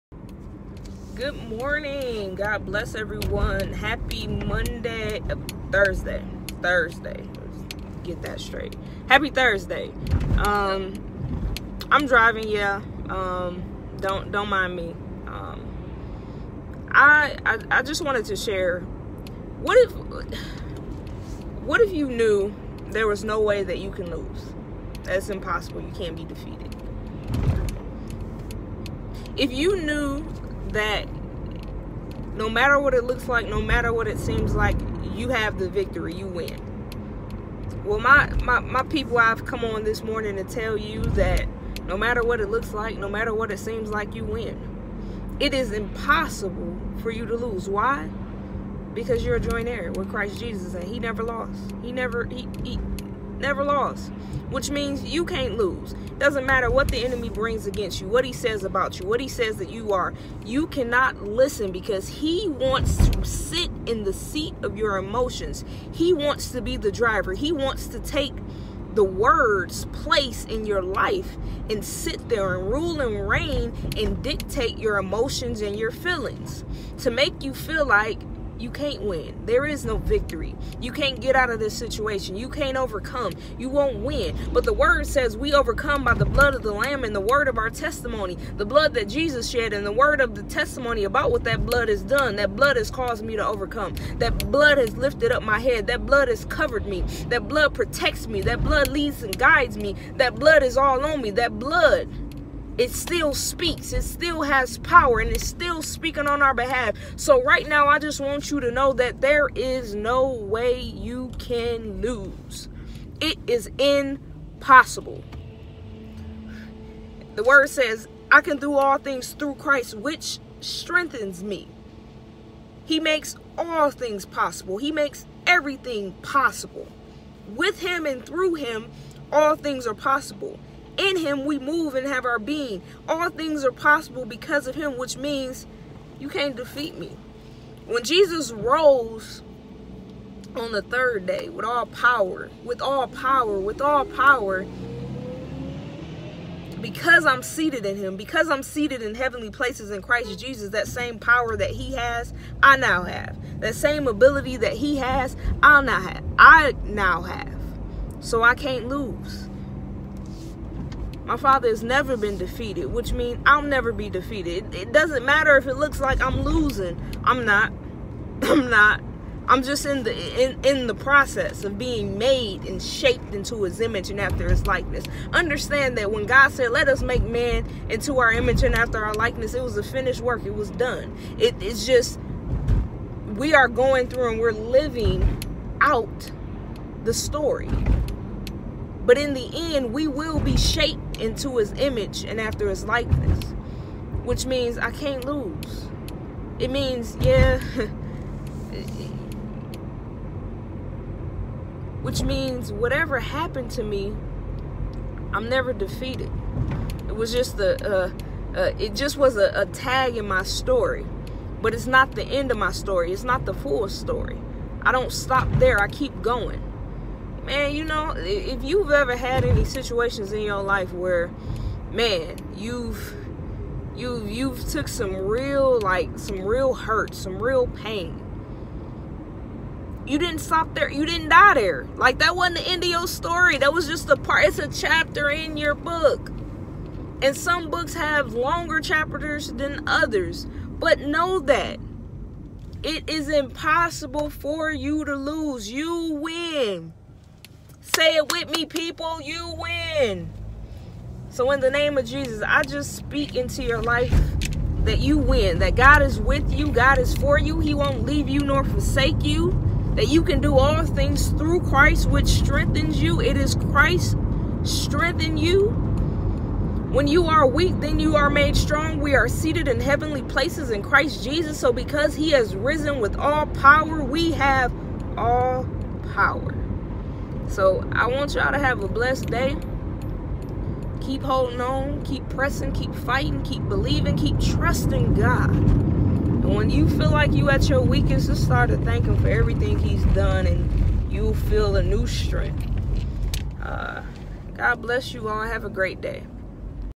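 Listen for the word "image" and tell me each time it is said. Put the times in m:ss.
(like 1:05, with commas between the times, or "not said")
2:53, 2:58, 3:11.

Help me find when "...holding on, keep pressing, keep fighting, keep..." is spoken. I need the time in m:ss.
4:41.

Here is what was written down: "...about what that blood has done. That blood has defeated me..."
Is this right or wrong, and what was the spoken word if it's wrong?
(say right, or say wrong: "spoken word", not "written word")
wrong: "caused", not "defeated".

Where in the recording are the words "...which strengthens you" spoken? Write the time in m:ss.
4:22.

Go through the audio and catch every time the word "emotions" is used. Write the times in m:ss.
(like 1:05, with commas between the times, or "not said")
1:04, 1:14.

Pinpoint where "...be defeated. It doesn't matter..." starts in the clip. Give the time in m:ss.
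2:43.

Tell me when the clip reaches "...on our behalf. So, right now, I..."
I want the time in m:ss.
1:46.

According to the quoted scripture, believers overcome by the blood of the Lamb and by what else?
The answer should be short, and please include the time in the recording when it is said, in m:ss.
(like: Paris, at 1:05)
The word of our testimony, at 1:27.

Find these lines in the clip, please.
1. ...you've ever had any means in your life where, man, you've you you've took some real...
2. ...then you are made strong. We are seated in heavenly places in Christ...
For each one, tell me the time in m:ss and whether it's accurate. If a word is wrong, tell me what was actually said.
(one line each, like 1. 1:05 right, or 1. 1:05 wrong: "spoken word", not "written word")
1. 3:38 wrong: "situations", not "means"
2. 4:27 right.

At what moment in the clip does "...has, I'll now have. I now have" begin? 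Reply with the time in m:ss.
2:34.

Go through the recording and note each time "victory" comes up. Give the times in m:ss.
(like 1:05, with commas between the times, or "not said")
0:35, 1:19.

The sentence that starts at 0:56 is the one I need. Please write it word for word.
Doesn't matter what the enemy brings against you, what he says about you, what he says that you are.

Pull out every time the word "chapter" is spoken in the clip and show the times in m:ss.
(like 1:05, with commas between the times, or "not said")
3:54, 3:58.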